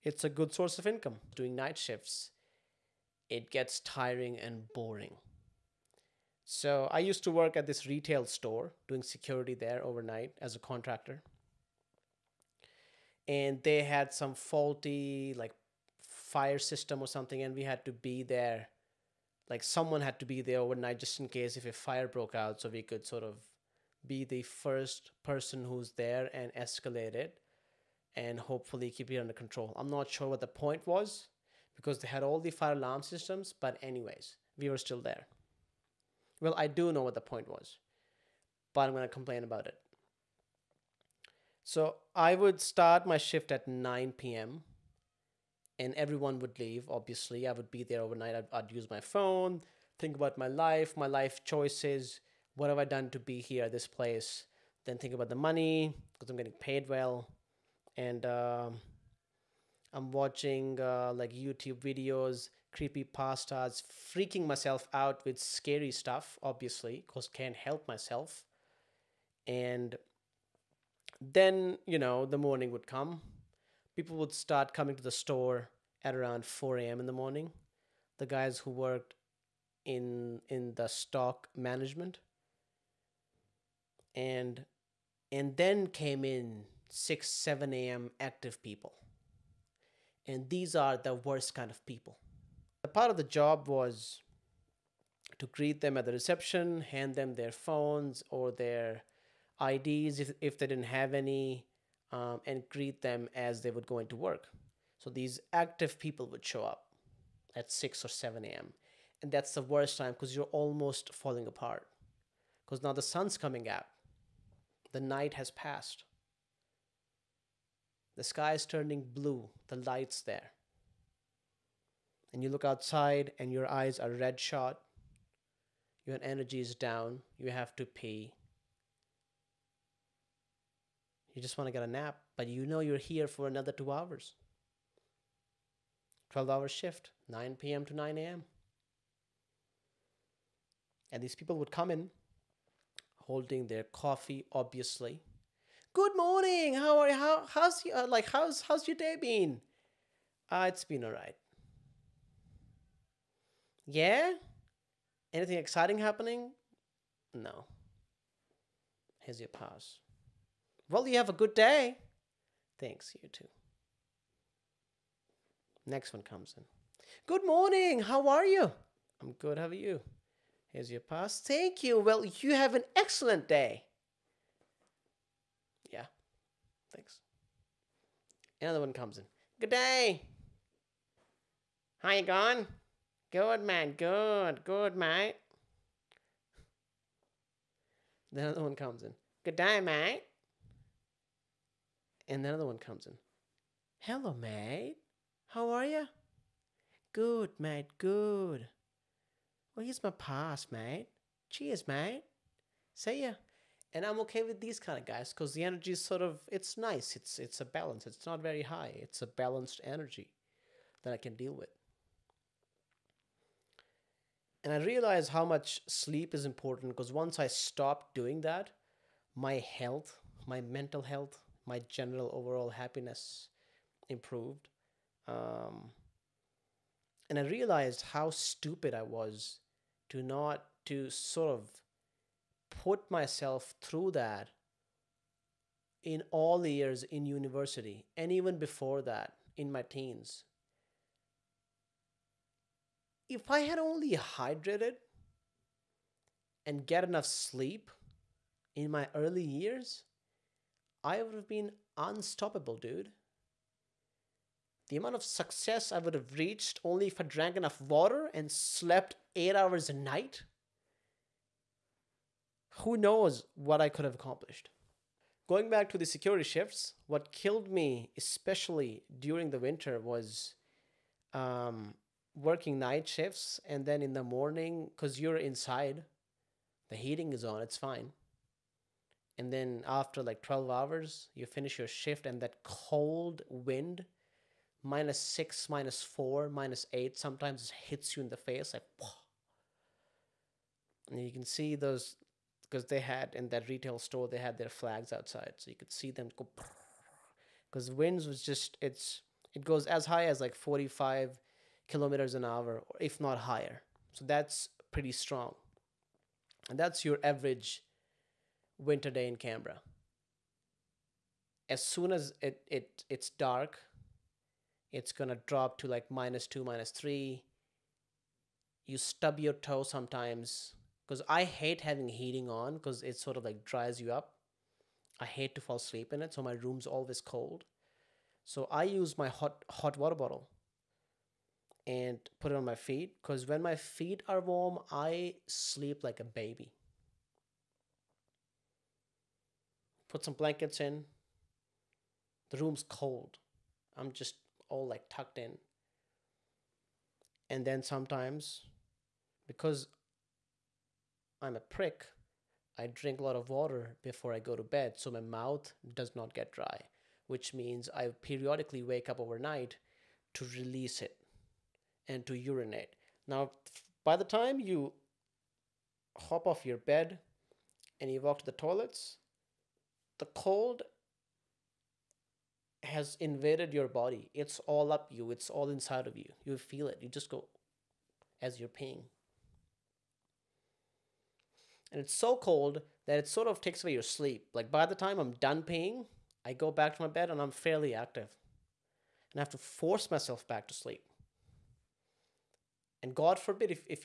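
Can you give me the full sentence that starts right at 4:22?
Who knows what I could have accomplished?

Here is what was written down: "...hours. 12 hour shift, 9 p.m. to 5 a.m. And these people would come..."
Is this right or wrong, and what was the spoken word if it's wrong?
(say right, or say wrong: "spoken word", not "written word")
wrong: "9", not "5".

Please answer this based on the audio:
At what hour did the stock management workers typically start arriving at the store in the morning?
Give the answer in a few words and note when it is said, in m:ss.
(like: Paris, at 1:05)
4 a.m., at 1:16.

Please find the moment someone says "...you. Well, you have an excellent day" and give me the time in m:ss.
2:51.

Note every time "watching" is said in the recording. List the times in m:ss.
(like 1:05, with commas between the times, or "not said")
1:00.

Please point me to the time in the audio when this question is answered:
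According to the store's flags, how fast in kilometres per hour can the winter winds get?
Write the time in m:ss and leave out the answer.
5:00.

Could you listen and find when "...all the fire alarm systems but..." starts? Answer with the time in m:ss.
0:32.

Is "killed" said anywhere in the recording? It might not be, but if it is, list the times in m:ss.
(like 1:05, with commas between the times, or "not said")
4:27.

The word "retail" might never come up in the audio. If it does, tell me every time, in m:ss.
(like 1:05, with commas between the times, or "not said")
0:07, 4:53.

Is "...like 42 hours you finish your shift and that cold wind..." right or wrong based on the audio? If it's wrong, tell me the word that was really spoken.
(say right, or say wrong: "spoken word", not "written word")
wrong: "12", not "42".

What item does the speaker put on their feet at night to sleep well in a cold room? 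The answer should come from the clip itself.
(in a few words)
hot water bottle.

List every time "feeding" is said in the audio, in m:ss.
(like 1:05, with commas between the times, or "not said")
not said.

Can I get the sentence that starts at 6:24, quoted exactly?
Like by the time I'm done peeing, I go back to my bed and I'm fairly active.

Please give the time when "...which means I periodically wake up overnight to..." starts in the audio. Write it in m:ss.
5:57.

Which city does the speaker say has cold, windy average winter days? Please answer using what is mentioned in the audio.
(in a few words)
Canberra.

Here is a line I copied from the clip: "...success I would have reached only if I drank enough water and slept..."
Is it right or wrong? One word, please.
right.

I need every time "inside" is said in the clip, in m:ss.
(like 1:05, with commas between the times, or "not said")
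4:35, 6:15.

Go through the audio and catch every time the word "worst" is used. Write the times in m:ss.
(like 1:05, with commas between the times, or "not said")
1:31, 1:49.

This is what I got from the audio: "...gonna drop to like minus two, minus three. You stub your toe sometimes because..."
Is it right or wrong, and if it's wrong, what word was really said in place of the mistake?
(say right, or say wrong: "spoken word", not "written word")
right.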